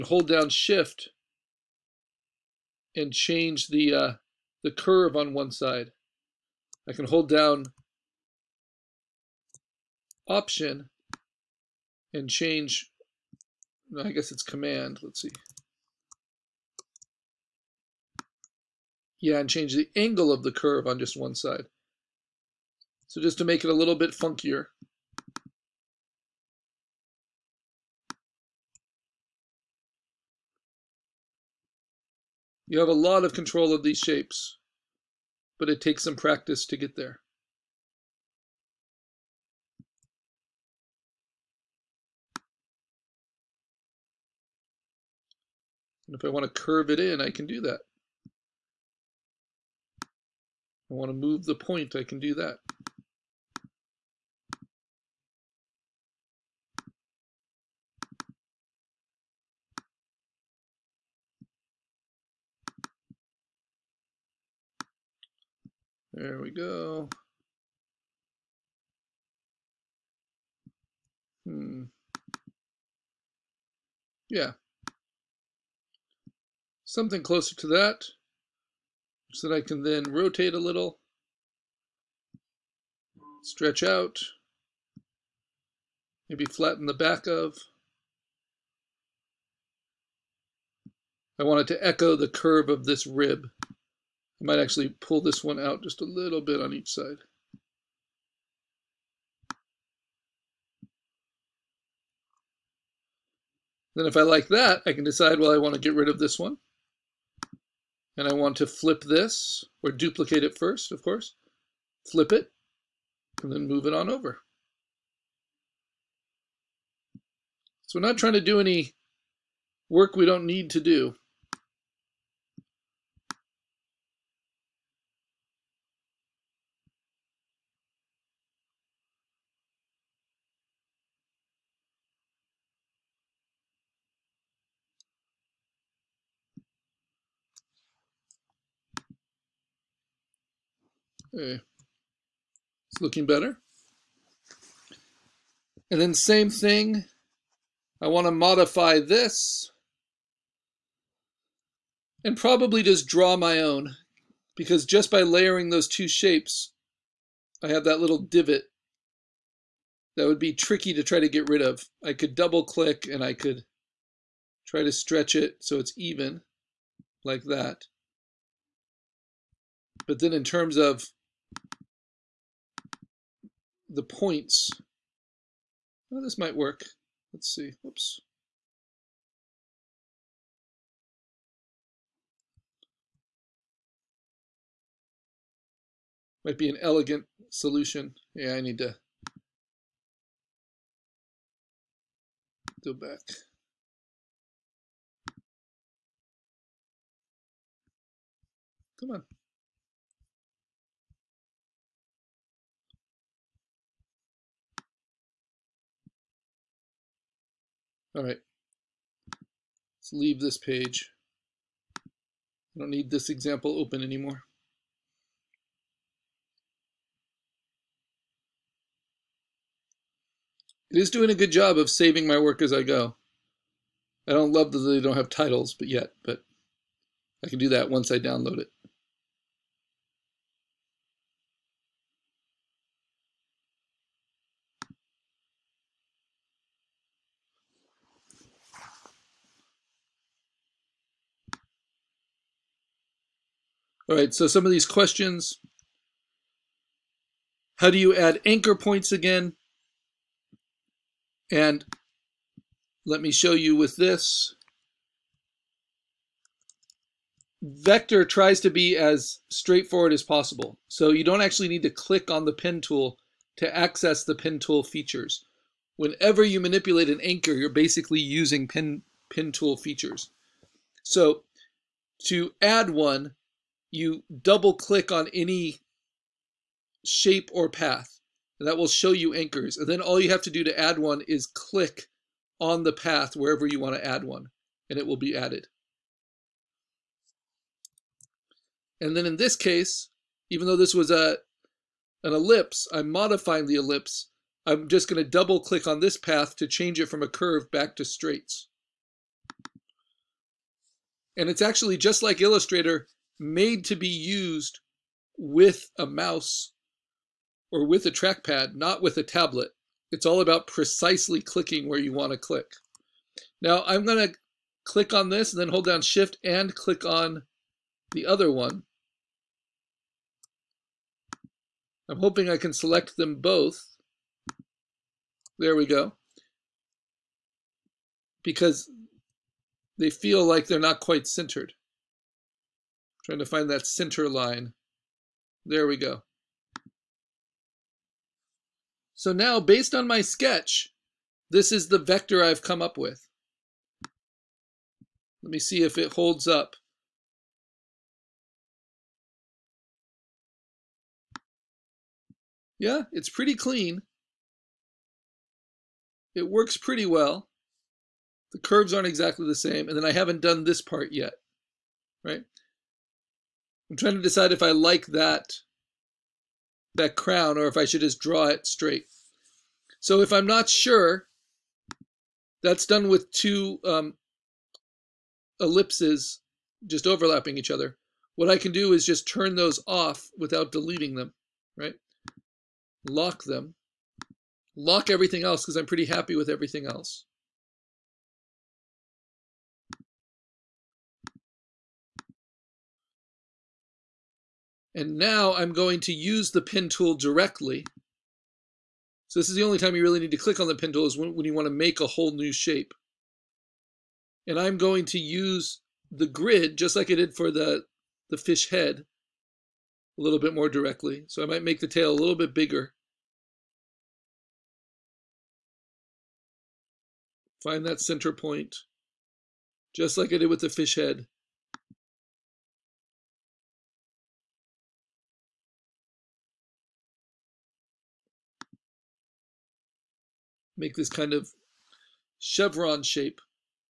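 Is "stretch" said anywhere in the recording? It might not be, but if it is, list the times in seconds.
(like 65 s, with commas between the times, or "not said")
83 s, 164 s.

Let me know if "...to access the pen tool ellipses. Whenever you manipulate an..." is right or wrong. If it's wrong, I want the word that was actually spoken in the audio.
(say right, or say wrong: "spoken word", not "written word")
wrong: "features", not "ellipses".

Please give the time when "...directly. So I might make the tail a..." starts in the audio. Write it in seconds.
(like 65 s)
410 s.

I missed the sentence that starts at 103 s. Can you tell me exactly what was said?
Then if I like that, I can decide, well, I want to get rid of this one.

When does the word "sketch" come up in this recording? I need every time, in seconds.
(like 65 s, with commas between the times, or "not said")
340 s.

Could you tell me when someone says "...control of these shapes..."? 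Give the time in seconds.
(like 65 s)
33 s.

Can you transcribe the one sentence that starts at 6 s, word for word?
I can hold down option and change, I guess it's command, let's see.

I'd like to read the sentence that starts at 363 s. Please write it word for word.
I'm trying to decide if I like that, that crown or if I should just draw it straight.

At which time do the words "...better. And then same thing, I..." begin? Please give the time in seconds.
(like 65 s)
143 s.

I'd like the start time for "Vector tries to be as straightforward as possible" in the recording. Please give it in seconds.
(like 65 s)
257 s.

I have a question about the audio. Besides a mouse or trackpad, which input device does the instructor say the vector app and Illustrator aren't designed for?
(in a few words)
A tablet.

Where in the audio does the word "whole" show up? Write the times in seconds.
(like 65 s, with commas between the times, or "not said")
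402 s.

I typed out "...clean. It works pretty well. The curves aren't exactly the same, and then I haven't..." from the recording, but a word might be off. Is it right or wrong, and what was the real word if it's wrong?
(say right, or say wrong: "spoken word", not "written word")
right.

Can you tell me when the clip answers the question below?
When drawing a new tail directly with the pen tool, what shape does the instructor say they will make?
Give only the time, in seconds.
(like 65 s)
432 s.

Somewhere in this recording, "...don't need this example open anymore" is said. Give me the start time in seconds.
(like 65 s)
212 s.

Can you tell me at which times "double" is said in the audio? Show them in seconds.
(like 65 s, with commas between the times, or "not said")
162 s, 274 s, 295 s.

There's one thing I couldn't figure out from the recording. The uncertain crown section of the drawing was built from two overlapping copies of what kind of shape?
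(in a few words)
Ellipses.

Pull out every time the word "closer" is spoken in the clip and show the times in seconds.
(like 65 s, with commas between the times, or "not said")
77 s.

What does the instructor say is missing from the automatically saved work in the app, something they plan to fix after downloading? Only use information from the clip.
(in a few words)
Titles.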